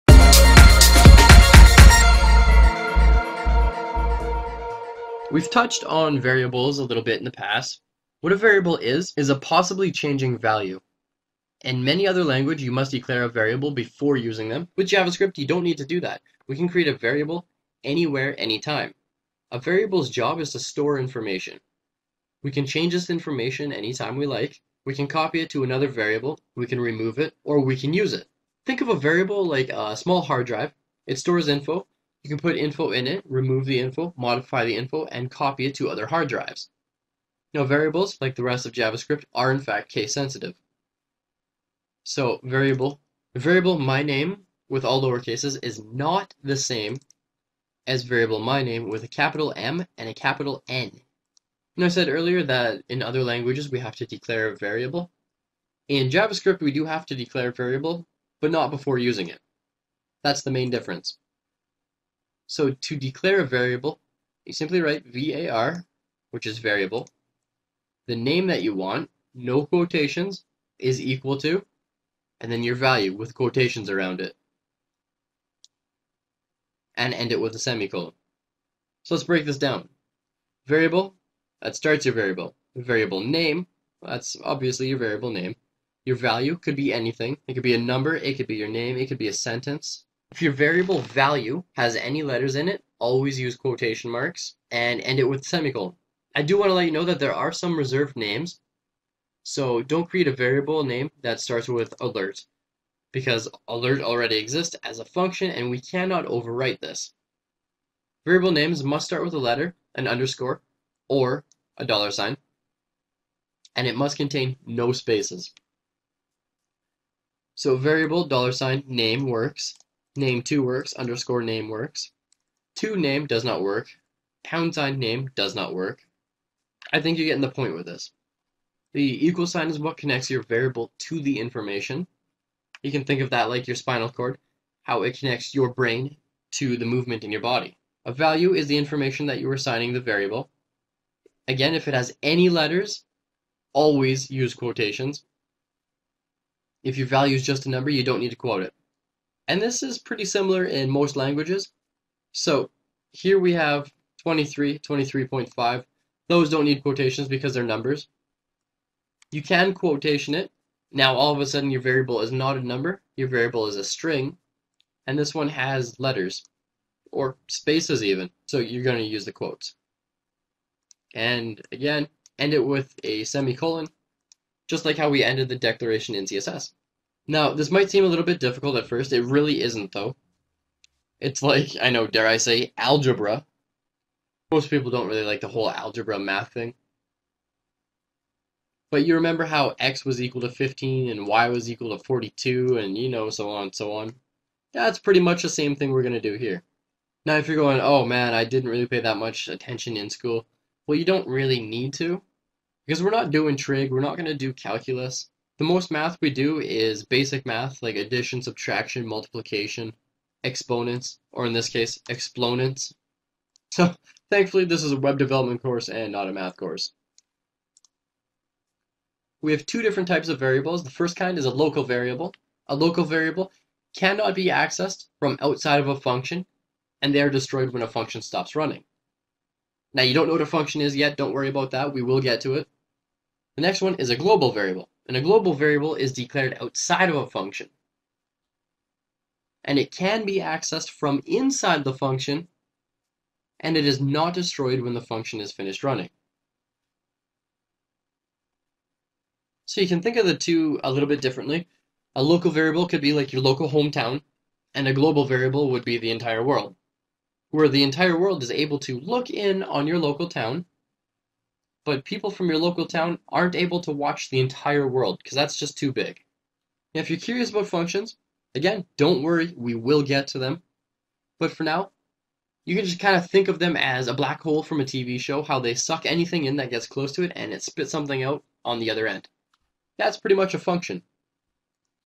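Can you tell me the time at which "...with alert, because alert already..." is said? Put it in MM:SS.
01:41.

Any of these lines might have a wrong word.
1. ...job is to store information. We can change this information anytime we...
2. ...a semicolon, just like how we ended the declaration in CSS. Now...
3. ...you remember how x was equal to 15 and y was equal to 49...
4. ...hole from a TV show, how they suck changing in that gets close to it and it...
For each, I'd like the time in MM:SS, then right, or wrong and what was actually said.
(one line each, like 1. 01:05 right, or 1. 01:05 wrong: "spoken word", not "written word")
1. 00:20 right
2. 02:53 right
3. 03:09 wrong: "42", not "49"
4. 04:34 wrong: "anything", not "changing".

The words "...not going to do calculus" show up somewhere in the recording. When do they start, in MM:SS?
03:24.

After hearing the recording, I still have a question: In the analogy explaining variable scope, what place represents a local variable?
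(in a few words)
local hometown.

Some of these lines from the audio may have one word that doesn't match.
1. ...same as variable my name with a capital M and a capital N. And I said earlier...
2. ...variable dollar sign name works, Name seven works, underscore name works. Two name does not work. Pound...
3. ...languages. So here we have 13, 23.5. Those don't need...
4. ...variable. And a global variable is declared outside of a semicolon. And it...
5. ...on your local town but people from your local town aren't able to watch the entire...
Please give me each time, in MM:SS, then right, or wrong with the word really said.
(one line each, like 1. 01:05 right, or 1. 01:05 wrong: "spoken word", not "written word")
1. 00:46 right
2. 01:57 wrong: "two", not "seven"
3. 02:31 wrong: "23", not "13"
4. 03:54 wrong: "function", not "semicolon"
5. 04:19 right.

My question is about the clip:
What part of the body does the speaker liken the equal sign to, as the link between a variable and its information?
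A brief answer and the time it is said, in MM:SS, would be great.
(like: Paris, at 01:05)
spinal cord, at 02:13.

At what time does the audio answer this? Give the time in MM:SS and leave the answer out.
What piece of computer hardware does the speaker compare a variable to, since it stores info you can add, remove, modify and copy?
00:29.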